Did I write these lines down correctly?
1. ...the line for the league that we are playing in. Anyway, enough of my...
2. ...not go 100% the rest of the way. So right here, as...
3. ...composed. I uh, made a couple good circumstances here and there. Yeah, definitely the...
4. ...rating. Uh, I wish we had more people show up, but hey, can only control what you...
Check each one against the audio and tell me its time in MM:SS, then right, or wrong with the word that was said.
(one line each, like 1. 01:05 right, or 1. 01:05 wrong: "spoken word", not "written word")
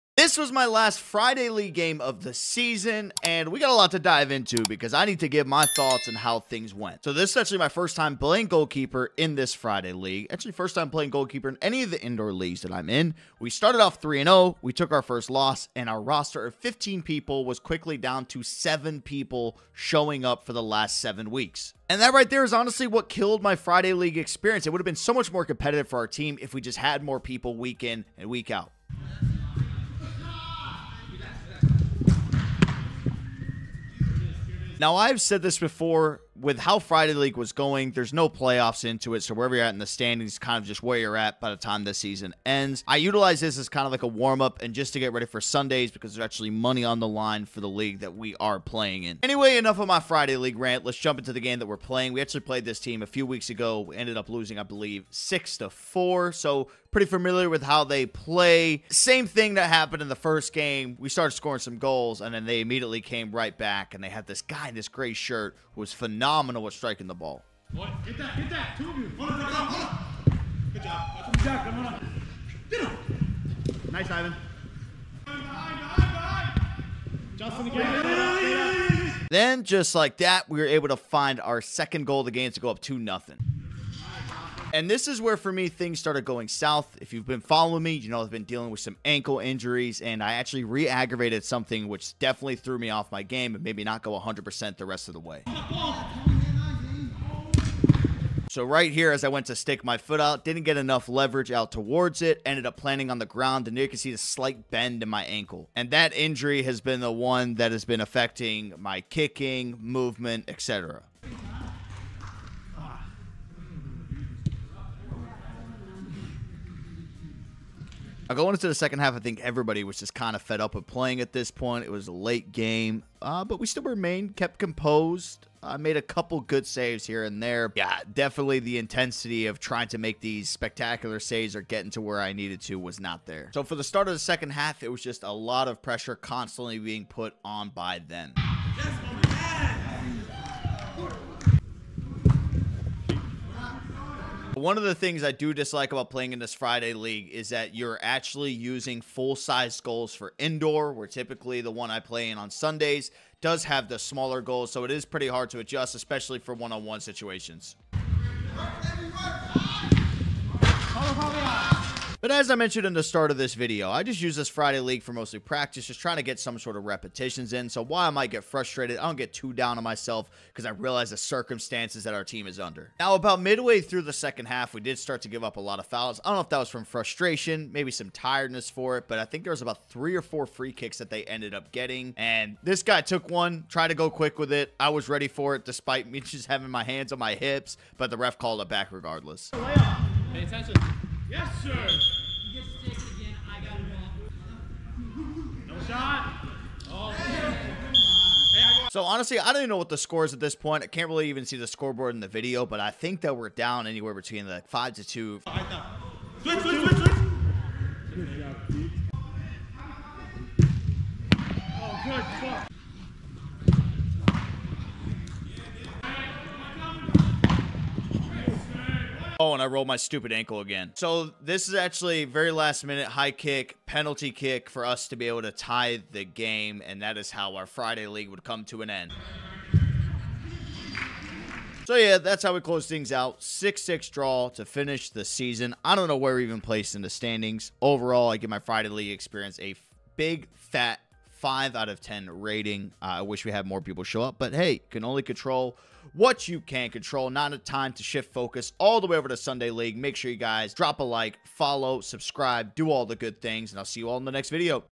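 1. 00:46 right
2. 01:33 right
3. 02:04 wrong: "saves", not "circumstances"
4. 04:02 right.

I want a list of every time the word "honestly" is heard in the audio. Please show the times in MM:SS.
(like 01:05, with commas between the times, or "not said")
00:22, 03:19.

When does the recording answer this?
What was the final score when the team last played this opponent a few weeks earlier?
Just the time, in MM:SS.
00:55.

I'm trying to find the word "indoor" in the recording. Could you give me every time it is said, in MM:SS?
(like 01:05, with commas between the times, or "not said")
00:12, 02:30.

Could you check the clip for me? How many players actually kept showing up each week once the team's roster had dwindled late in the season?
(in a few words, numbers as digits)
7.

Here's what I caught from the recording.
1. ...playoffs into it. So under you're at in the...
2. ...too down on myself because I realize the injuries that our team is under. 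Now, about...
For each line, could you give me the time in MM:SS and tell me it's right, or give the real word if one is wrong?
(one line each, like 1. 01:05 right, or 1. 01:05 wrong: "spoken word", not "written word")
1. 00:38 wrong: "wherever", not "under"
2. 02:49 wrong: "circumstances", not "injuries".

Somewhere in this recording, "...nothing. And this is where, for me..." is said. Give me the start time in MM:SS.
01:22.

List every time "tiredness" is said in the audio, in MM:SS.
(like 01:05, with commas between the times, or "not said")
02:58.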